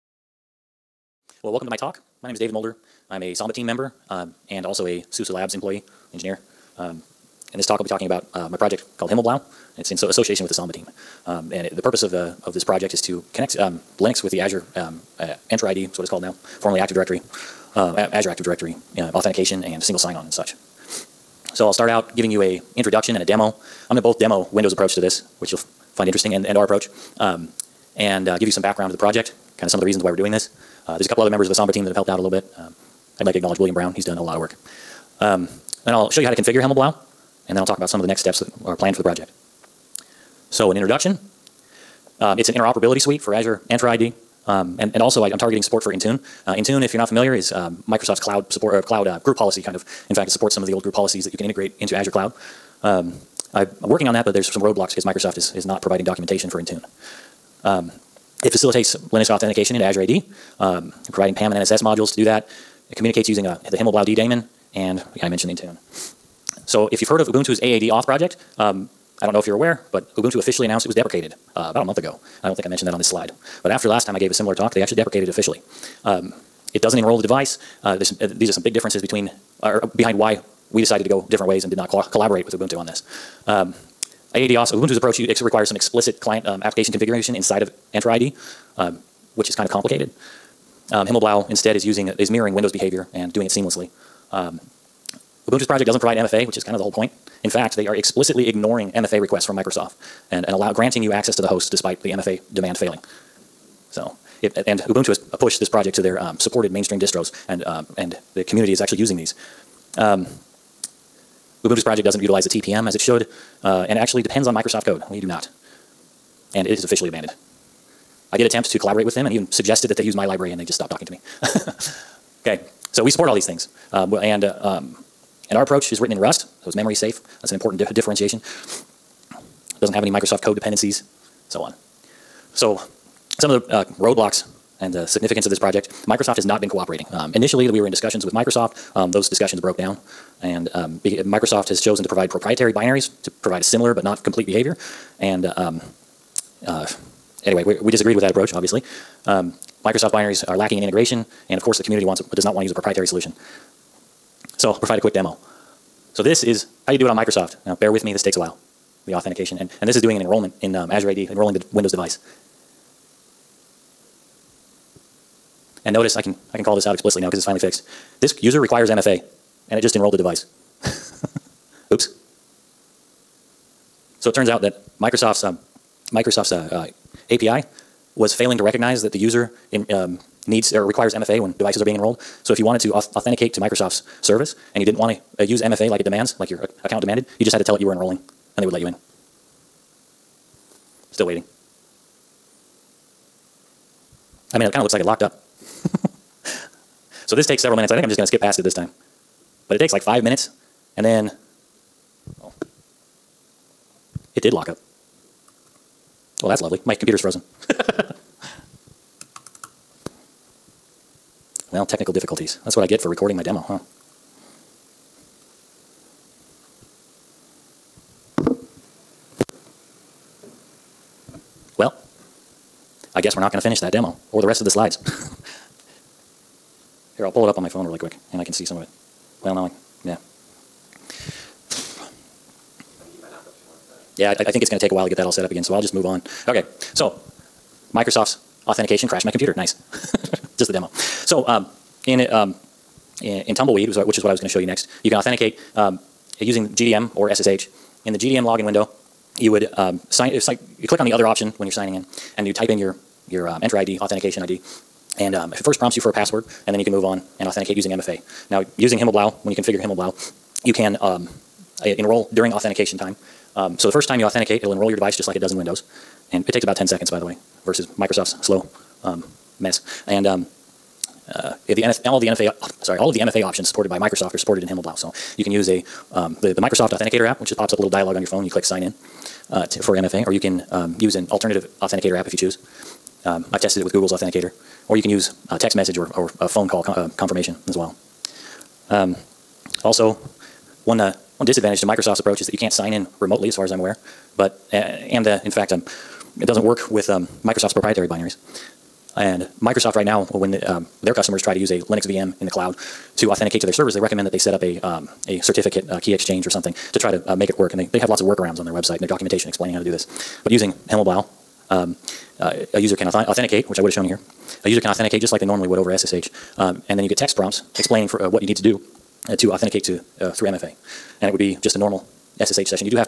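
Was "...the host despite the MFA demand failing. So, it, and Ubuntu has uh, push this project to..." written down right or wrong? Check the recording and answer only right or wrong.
right.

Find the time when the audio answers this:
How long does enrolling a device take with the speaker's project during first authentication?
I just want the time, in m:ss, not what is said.
4:26.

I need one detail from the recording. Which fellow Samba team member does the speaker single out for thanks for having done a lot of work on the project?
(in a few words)
William Brown.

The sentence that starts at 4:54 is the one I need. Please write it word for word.
But uh, and in fact, um, it doesn't work with um, Microsoft's proprietary binaries.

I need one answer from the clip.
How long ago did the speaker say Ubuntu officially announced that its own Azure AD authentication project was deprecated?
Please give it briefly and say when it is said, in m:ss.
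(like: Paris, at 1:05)
About a month ago, at 1:11.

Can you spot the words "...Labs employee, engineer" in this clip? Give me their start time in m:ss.
0:05.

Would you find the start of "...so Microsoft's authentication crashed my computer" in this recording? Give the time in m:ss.
3:56.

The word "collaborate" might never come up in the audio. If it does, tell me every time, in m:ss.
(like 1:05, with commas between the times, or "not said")
1:22, 1:58.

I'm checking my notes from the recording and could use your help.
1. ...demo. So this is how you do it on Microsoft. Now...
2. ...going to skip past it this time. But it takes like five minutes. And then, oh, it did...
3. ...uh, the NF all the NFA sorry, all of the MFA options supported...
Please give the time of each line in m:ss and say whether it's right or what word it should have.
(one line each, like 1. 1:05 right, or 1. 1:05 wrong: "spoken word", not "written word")
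1. 2:35 right
2. 3:18 right
3. 4:31 right.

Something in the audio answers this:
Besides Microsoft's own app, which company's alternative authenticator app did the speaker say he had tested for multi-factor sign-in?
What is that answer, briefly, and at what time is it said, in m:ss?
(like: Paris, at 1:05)
Google, at 4:43.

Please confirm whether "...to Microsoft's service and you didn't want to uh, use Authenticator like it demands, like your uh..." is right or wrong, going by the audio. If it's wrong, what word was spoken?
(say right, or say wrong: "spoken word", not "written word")
wrong: "MFA", not "Authenticator".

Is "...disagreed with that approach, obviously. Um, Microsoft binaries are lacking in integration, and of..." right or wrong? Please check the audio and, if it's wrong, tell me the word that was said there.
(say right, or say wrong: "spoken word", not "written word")
right.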